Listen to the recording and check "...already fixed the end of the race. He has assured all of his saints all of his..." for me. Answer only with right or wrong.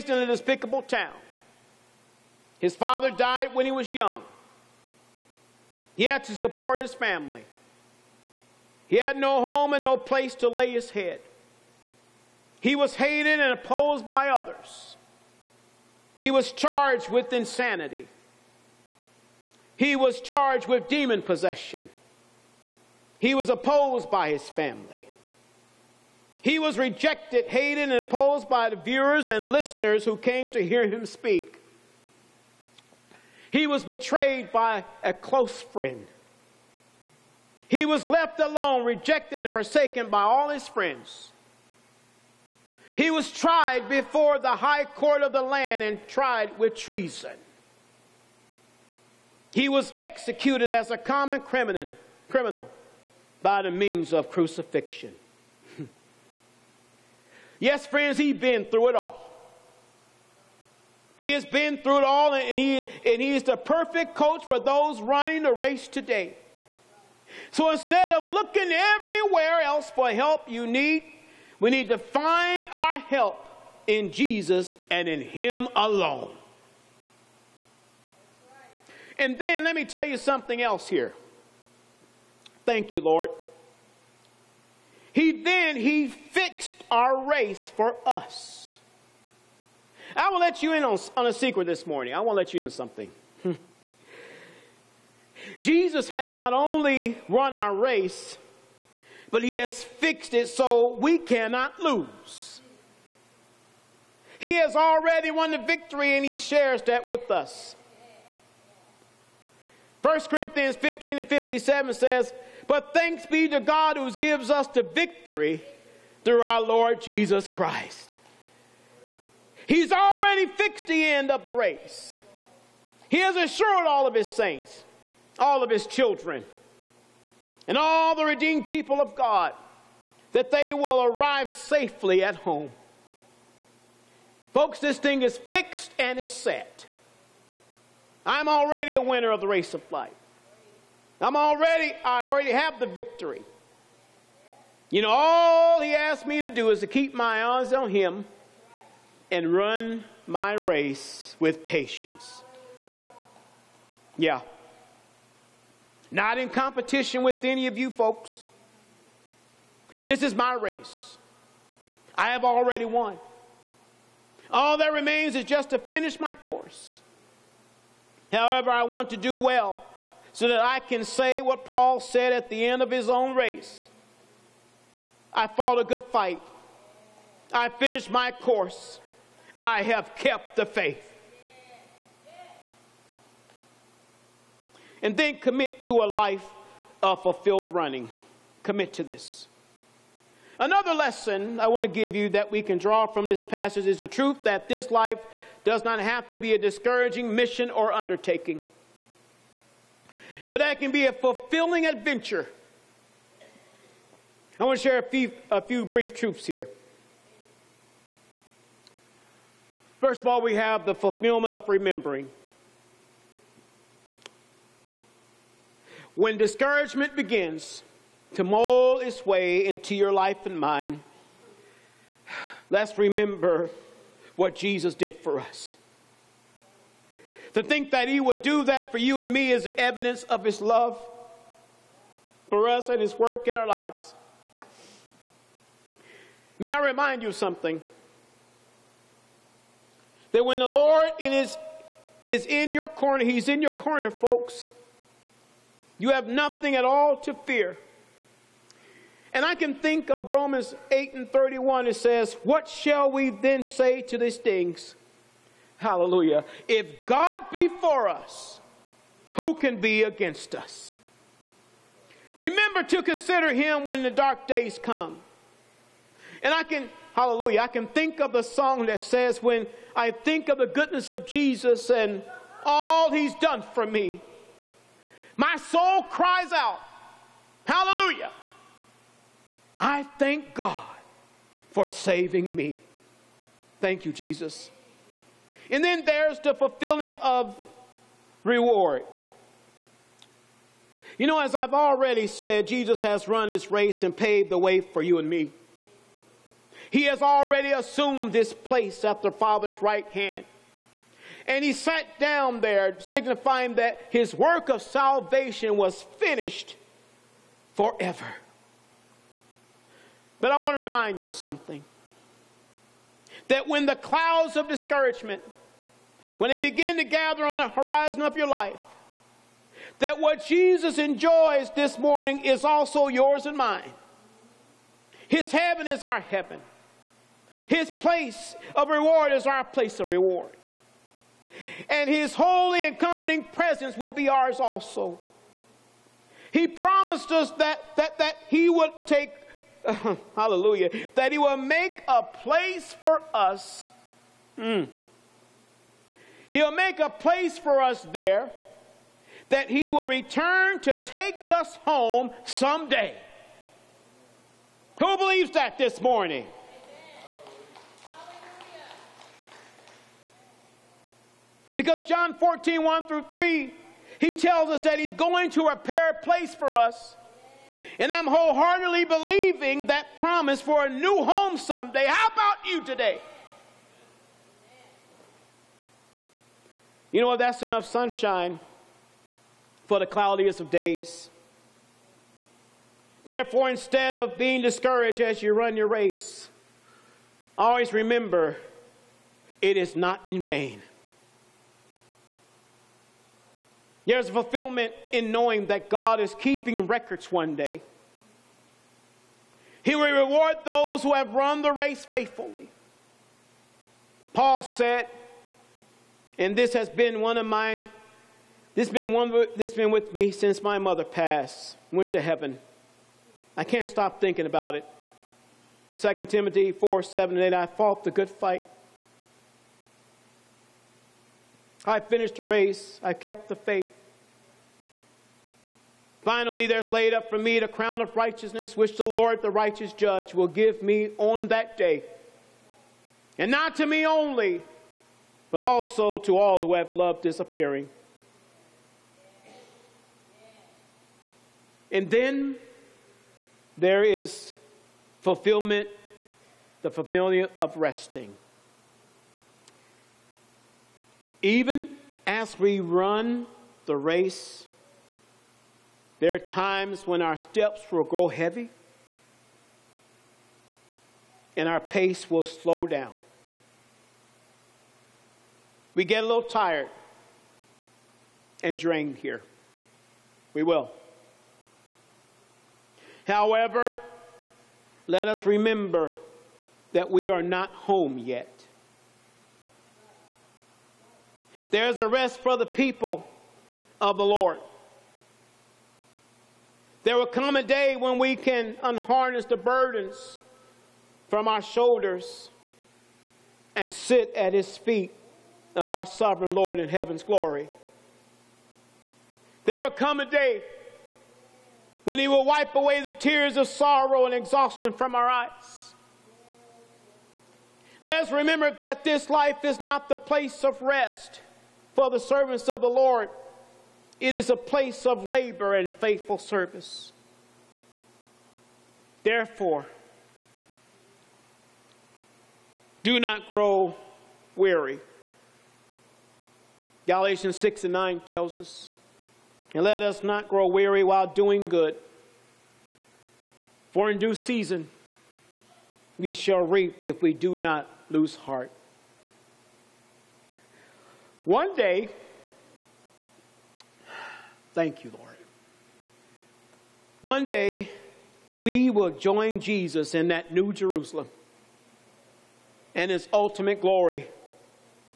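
right.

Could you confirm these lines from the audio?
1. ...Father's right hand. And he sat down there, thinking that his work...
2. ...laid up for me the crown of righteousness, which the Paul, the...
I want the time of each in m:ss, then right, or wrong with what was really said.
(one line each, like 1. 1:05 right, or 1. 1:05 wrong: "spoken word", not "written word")
1. 4:59 wrong: "signifying", not "thinking"
2. 7:06 wrong: "Lord", not "Paul".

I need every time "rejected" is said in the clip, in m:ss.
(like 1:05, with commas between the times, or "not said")
0:26, 0:38.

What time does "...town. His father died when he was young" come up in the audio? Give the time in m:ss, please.
0:00.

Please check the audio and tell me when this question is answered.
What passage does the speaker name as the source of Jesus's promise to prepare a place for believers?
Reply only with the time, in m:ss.
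6:02.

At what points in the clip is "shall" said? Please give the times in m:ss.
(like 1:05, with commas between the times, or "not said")
4:12, 8:56.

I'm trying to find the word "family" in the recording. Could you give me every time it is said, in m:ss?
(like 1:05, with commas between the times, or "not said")
0:06, 0:24.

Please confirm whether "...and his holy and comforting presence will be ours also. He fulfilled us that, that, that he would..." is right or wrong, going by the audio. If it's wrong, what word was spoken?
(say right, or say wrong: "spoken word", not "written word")
wrong: "promised", not "fulfilled".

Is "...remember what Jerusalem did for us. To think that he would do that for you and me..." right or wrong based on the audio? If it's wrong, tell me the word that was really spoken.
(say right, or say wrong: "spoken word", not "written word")
wrong: "Jesus", not "Jerusalem".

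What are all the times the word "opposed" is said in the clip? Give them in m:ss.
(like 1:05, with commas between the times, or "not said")
0:13, 0:23, 0:27.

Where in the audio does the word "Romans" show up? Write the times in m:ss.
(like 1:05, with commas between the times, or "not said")
4:10.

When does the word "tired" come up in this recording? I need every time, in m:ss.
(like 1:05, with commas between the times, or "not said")
7:46.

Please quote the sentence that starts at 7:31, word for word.
Even as we run the race, there are times when our steps will grow heavy and our pace will slow down.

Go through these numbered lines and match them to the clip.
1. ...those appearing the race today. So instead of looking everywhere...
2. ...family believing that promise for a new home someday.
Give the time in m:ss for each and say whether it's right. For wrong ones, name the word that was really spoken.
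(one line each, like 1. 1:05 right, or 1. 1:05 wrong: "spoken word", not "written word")
1. 1:04 wrong: "running", not "appearing"
2. 6:08 wrong: "wholeheartedly", not "family".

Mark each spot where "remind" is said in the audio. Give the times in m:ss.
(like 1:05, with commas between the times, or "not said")
3:56, 5:10.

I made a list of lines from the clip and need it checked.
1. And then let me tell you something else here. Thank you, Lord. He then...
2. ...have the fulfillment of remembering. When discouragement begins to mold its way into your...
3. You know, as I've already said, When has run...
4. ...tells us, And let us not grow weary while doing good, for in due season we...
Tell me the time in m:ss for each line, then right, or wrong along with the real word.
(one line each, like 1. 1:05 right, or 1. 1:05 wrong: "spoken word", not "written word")
1. 1:19 right
2. 3:30 right
3. 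4:51 wrong: "Jesus", not "When"
4. 8:48 right.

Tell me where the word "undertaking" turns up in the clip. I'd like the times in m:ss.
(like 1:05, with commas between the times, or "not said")
3:17.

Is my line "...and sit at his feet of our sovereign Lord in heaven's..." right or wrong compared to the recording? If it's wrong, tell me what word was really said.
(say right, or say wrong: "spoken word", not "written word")
right.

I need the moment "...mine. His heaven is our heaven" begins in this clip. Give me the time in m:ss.
5:23.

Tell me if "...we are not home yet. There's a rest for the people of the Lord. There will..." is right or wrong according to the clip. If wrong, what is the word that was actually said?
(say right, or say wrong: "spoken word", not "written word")
right.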